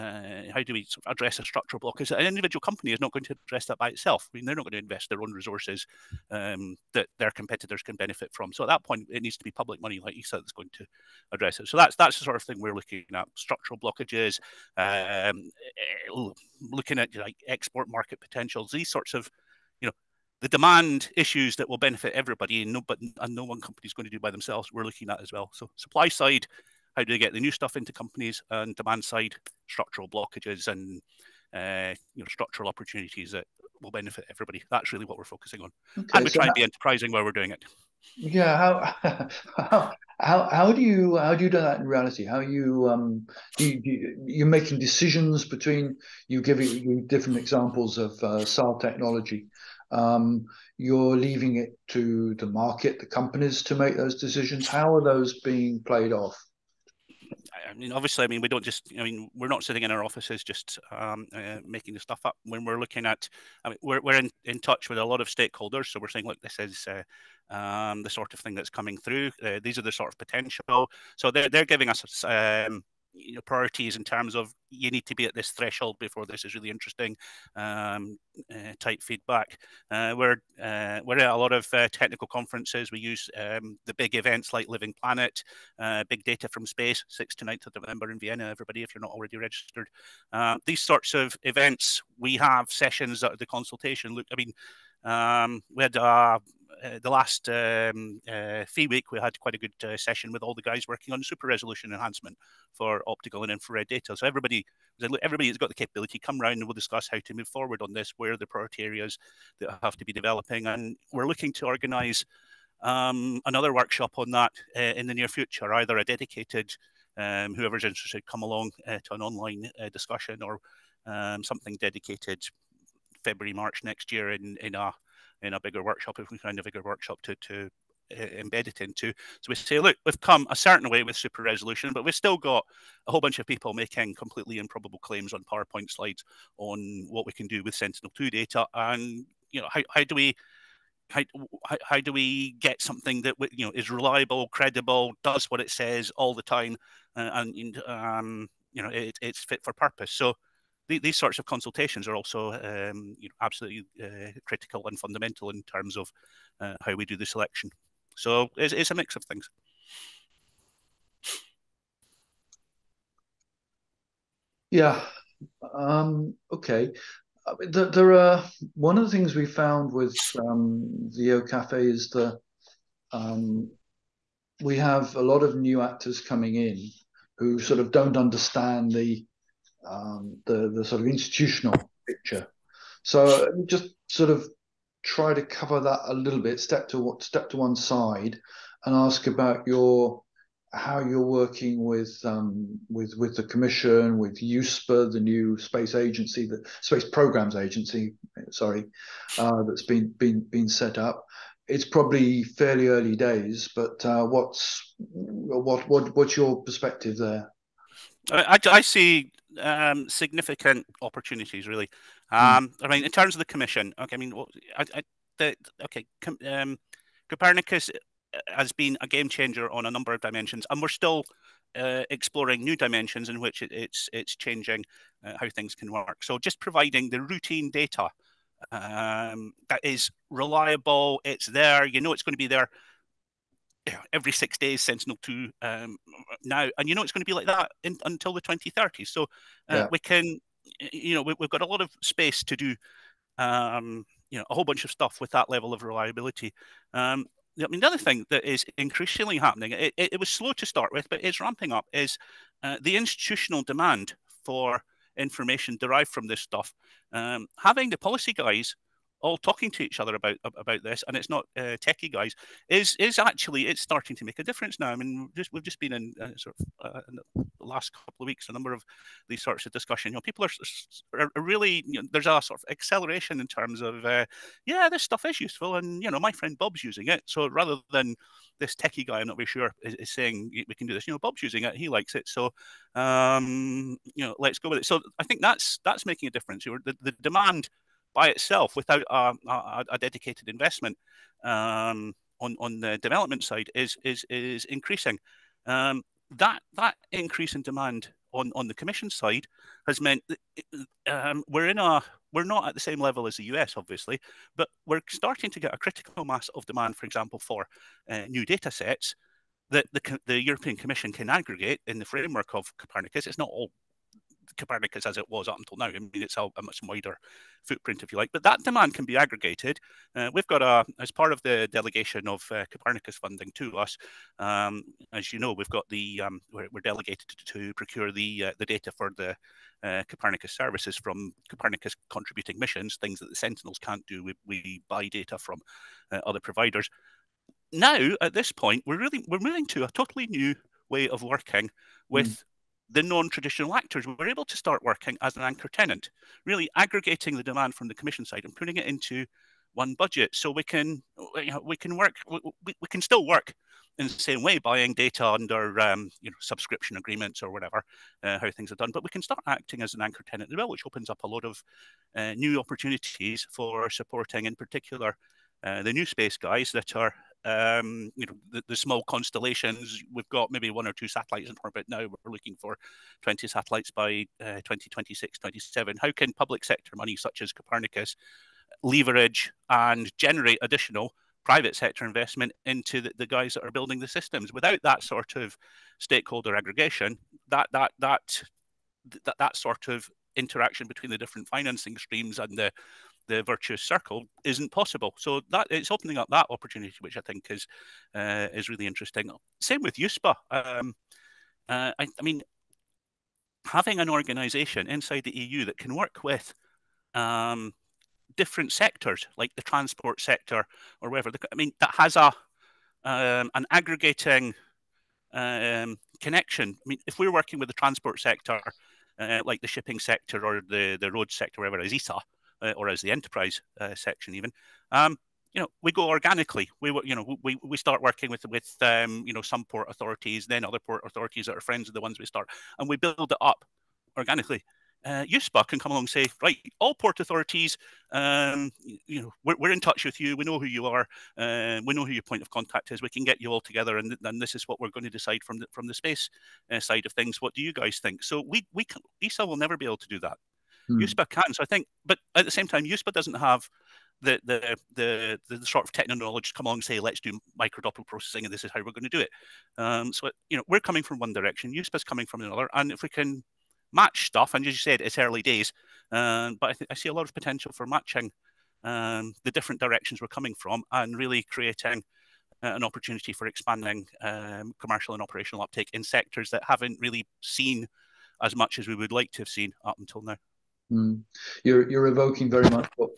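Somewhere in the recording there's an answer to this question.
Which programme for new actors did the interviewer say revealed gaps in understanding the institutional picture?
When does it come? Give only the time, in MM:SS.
02:51.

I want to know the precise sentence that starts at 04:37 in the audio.
So rather than this techie guy, I'm not very sure is, is saying we can do this.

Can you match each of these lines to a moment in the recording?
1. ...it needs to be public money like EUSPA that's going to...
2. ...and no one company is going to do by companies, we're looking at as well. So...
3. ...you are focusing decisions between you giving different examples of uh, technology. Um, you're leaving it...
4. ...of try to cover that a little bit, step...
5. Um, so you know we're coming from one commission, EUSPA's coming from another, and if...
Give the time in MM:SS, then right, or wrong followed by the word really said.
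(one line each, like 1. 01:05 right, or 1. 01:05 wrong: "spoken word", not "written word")
1. 00:09 wrong: "ESA", not "EUSPA"
2. 00:23 wrong: "themselves", not "companies"
3. 00:44 wrong: "making", not "focusing"
4. 03:04 right
5. 07:39 wrong: "direction", not "commission".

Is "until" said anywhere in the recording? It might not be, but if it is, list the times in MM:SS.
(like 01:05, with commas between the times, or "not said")
03:58, 05:15, 07:59.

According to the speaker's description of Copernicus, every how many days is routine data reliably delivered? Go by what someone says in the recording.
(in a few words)
6.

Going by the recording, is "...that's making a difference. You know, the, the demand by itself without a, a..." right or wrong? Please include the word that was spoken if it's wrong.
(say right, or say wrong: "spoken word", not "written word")
right.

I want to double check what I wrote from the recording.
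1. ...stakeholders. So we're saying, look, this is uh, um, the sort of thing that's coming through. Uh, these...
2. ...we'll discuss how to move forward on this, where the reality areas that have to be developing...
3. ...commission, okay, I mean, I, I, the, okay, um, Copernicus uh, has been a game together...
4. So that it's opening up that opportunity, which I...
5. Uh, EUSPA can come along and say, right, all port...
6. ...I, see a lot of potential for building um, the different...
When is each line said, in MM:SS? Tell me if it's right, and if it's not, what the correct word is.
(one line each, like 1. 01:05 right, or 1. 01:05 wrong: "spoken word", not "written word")
1. 01:05 right
2. 01:46 wrong: "priority", not "reality"
3. 03:33 wrong: "changer", not "together"
4. 06:35 right
5. 07:15 right
6. 07:46 wrong: "matching", not "building".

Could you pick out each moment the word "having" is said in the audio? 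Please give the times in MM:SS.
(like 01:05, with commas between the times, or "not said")
04:17, 06:43.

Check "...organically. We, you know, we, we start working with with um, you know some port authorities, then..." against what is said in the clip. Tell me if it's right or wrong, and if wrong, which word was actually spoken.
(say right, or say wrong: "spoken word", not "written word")
right.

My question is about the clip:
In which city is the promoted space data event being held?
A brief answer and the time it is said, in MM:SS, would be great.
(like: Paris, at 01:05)
Vienna, at 01:28.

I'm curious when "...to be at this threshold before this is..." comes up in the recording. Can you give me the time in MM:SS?
01:15.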